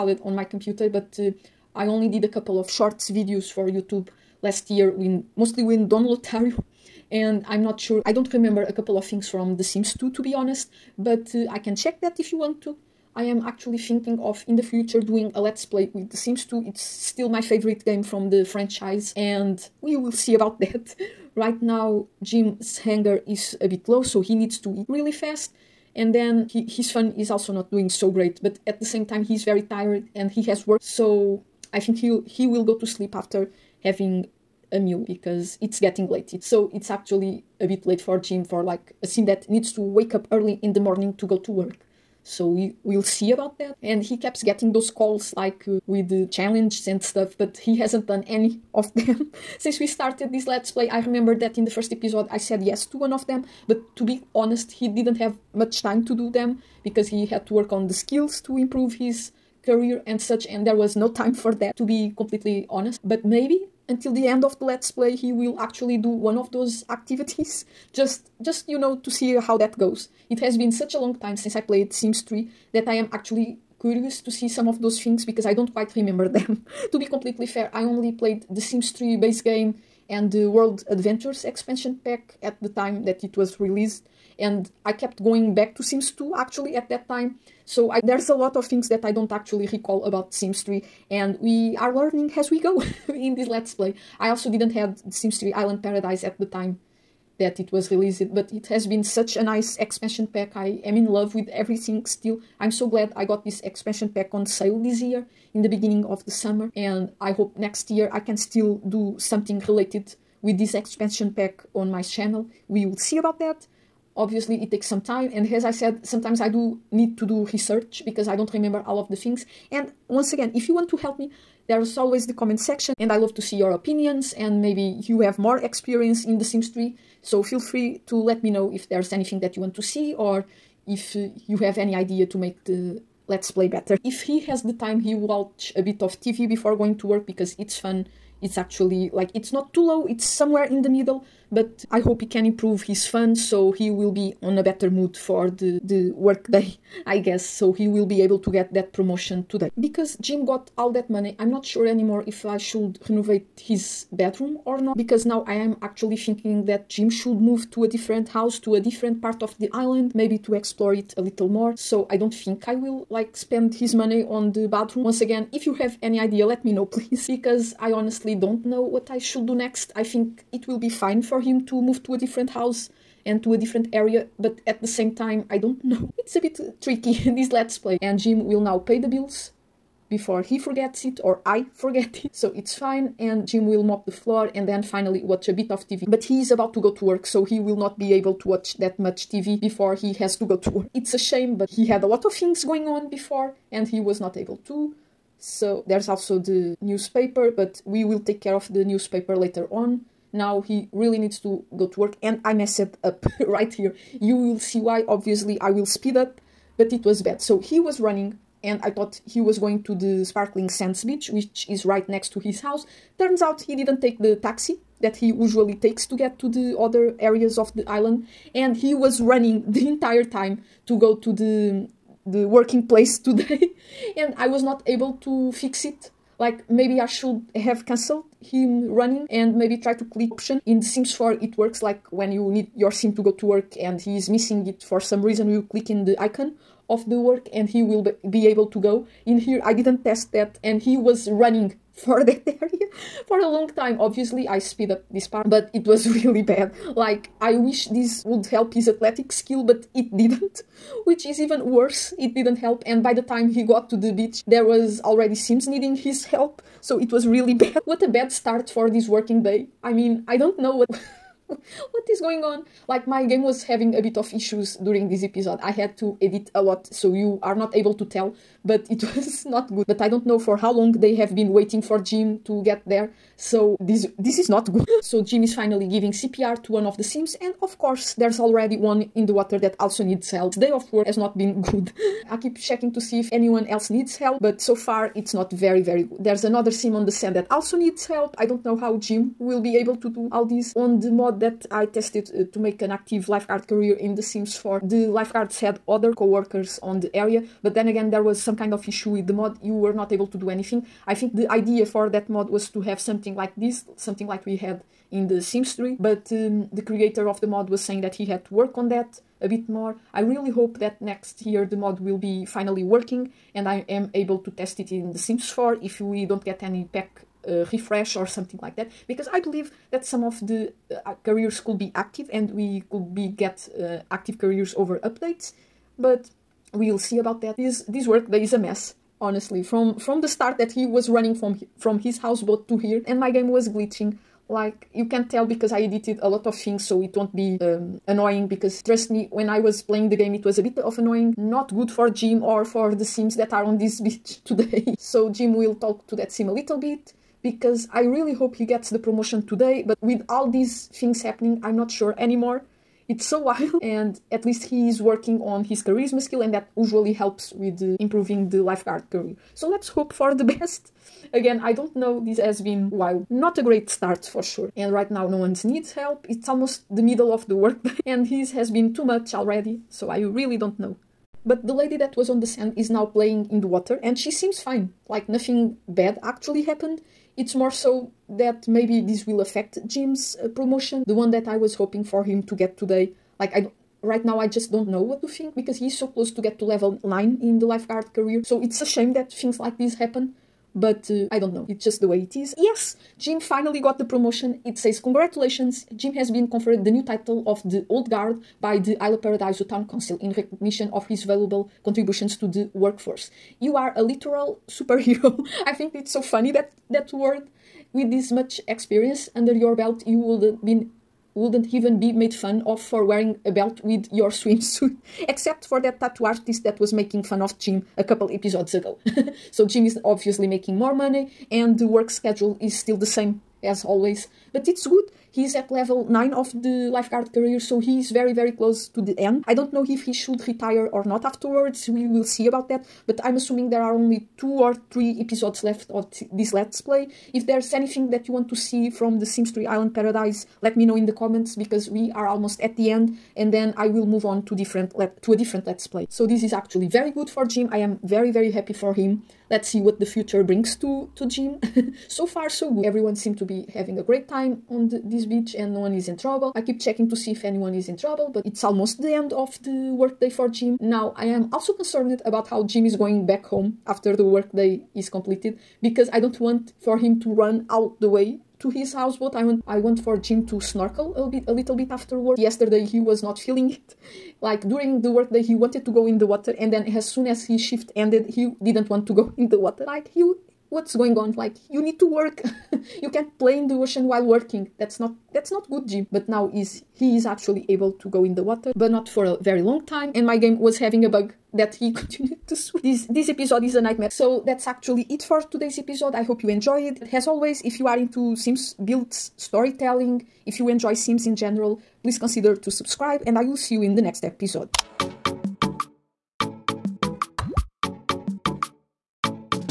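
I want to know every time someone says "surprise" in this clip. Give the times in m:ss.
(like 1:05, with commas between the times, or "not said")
not said.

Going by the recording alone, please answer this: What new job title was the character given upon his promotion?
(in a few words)
The Old Guard.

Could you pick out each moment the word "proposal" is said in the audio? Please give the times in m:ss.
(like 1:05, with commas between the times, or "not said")
not said.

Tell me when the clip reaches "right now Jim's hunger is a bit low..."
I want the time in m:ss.
0:21.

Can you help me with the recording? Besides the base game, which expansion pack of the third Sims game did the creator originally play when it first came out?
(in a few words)
World Adventures.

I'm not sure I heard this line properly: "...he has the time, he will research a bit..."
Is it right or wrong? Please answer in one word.
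wrong.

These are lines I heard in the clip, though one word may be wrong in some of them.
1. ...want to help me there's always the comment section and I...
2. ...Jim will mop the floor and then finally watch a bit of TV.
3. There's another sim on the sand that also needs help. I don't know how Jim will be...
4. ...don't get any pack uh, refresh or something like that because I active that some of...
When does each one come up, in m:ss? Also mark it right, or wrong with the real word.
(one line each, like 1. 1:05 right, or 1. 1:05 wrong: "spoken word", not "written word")
1. 2:00 right
2. 3:03 right
3. 4:46 right
4. 5:16 wrong: "believe", not "active".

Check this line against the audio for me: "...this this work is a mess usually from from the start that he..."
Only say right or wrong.
wrong.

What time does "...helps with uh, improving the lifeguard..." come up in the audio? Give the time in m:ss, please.
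5:57.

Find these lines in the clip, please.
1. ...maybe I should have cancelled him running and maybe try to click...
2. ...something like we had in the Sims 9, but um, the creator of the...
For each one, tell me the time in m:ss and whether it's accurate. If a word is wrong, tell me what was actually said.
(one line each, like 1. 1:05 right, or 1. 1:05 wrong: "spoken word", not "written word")
1. 3:46 right
2. 5:03 wrong: "3", not "9".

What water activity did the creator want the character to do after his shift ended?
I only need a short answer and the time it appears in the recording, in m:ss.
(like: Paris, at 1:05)
Snorkel, at 7:50.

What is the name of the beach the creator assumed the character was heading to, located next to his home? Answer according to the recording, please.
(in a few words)
Sparkling Sands.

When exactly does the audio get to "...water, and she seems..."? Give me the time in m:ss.
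6:13.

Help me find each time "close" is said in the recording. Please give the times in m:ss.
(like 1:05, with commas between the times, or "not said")
6:26, 7:08.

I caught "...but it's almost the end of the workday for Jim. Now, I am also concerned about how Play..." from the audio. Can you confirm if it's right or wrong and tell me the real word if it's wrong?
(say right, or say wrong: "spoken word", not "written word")
wrong: "Jim", not "Play".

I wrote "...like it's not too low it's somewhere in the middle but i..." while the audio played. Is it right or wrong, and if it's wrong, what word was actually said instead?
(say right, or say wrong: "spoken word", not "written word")
right.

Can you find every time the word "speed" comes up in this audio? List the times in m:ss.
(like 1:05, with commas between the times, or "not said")
3:25, 4:04.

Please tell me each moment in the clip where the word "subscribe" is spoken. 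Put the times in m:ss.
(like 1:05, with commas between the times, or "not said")
8:22.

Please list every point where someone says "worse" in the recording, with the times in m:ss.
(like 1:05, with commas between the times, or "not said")
4:11.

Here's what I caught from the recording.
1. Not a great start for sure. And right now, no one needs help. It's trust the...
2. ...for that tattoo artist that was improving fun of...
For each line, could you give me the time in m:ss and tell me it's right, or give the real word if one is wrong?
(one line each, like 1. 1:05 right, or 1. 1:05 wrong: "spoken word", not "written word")
1. 6:03 wrong: "almost", not "trust"
2. 6:55 wrong: "making", not "improving".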